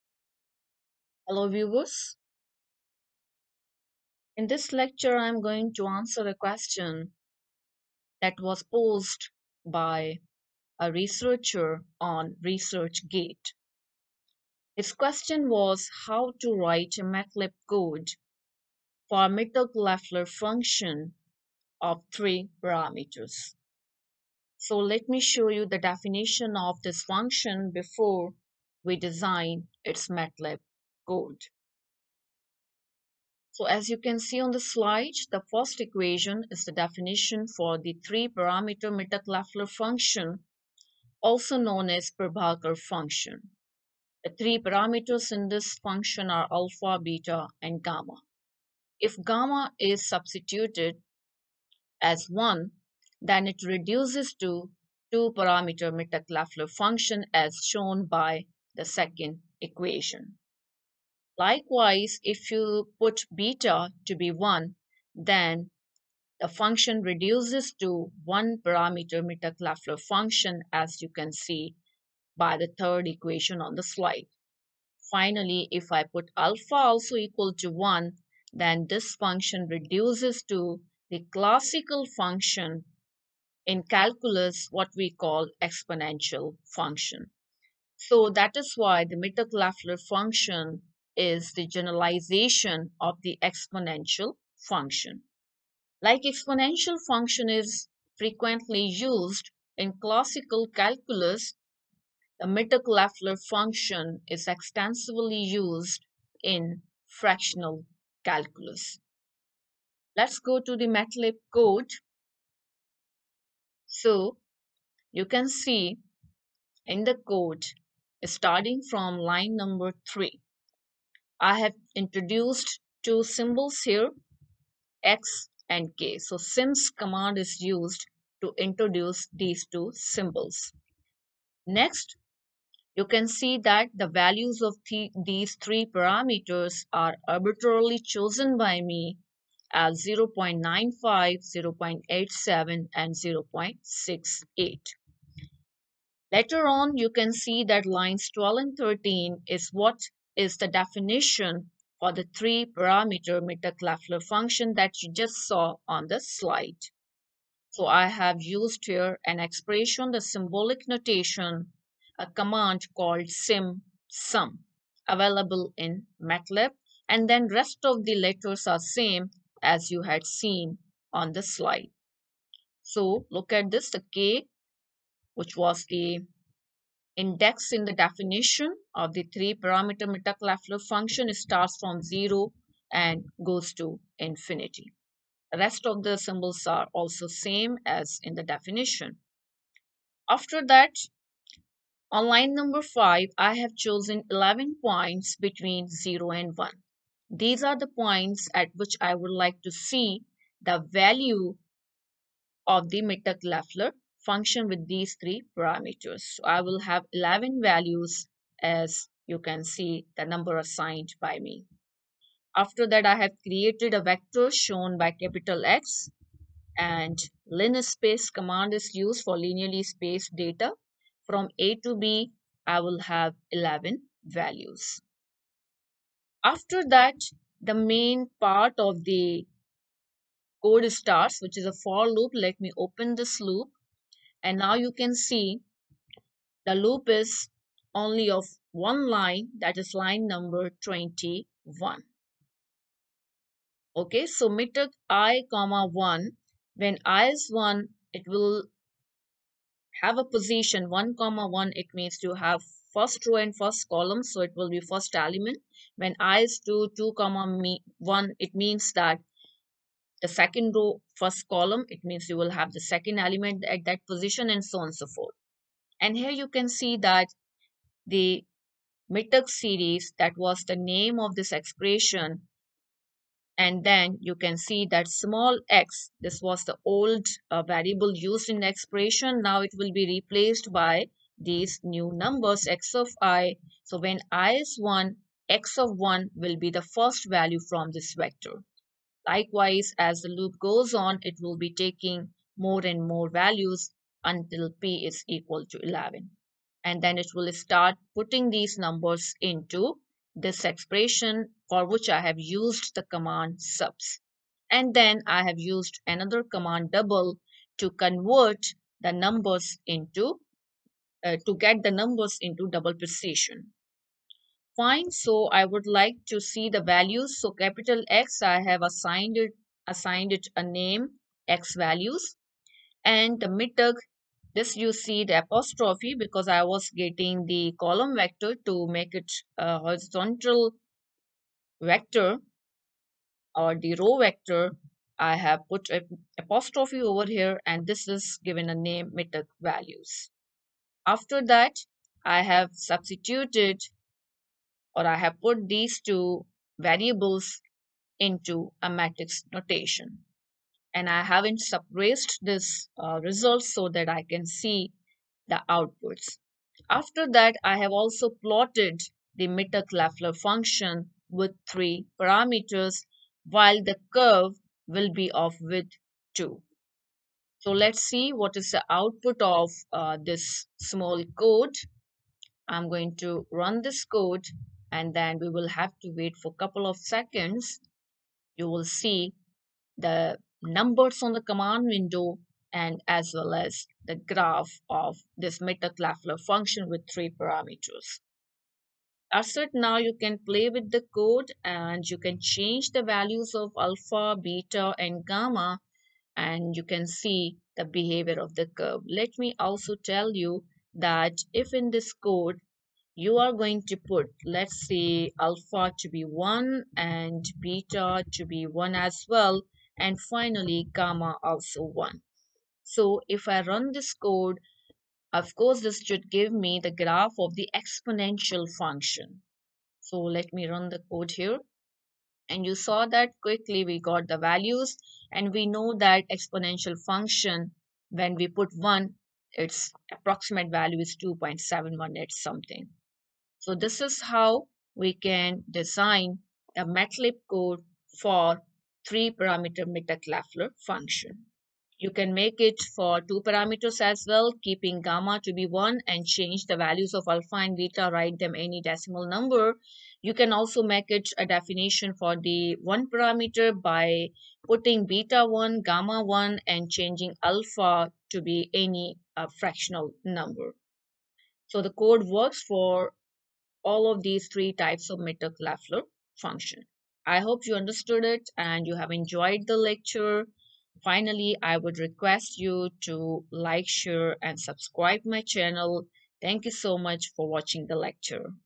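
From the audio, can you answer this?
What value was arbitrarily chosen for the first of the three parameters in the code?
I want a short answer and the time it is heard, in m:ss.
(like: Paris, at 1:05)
0.95, at 2:20.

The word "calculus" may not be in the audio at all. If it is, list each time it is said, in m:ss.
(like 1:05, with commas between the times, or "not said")
1:23, 1:40, 1:48.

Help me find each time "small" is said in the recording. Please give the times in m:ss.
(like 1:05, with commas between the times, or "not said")
4:35, 6:10.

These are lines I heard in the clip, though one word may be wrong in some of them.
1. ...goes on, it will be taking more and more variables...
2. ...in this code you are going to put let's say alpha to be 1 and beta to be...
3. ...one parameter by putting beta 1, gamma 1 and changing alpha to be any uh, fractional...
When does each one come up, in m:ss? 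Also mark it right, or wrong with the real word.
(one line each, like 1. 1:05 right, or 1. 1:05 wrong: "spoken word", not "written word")
1. 4:50 wrong: "values", not "variables"
2. 6:41 right
3. 7:32 right.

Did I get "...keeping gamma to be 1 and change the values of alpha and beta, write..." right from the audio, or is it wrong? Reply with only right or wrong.
right.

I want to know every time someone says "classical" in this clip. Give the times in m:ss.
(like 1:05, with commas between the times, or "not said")
1:21, 1:40.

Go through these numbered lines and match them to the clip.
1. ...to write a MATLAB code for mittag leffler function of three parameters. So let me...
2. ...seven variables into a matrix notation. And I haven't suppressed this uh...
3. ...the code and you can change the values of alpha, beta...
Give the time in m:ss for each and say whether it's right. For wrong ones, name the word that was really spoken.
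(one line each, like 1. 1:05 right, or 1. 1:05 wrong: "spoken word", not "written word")
1. 0:16 right
2. 5:46 wrong: "two", not "seven"
3. 6:30 right.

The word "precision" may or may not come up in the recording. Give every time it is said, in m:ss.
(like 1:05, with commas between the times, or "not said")
5:12.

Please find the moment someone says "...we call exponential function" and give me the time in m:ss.
1:24.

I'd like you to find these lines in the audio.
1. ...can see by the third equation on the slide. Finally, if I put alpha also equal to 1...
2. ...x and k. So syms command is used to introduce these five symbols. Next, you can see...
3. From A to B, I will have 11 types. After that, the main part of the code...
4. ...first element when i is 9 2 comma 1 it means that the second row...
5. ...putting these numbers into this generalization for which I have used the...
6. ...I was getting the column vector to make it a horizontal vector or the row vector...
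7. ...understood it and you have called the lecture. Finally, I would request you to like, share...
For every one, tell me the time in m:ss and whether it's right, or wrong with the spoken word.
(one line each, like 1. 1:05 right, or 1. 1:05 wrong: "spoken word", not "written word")
1. 1:11 right
2. 2:05 wrong: "two", not "five"
3. 3:41 wrong: "values", not "types"
4. 4:14 wrong: "2", not "9"
5. 4:58 wrong: "expression", not "generalization"
6. 5:26 right
7. 7:47 wrong: "enjoyed", not "called".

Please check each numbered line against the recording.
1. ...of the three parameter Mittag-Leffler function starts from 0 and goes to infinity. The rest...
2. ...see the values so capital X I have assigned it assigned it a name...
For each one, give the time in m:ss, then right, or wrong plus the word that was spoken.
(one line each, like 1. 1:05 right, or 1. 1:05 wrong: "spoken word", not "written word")
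1. 2:58 right
2. 5:16 right.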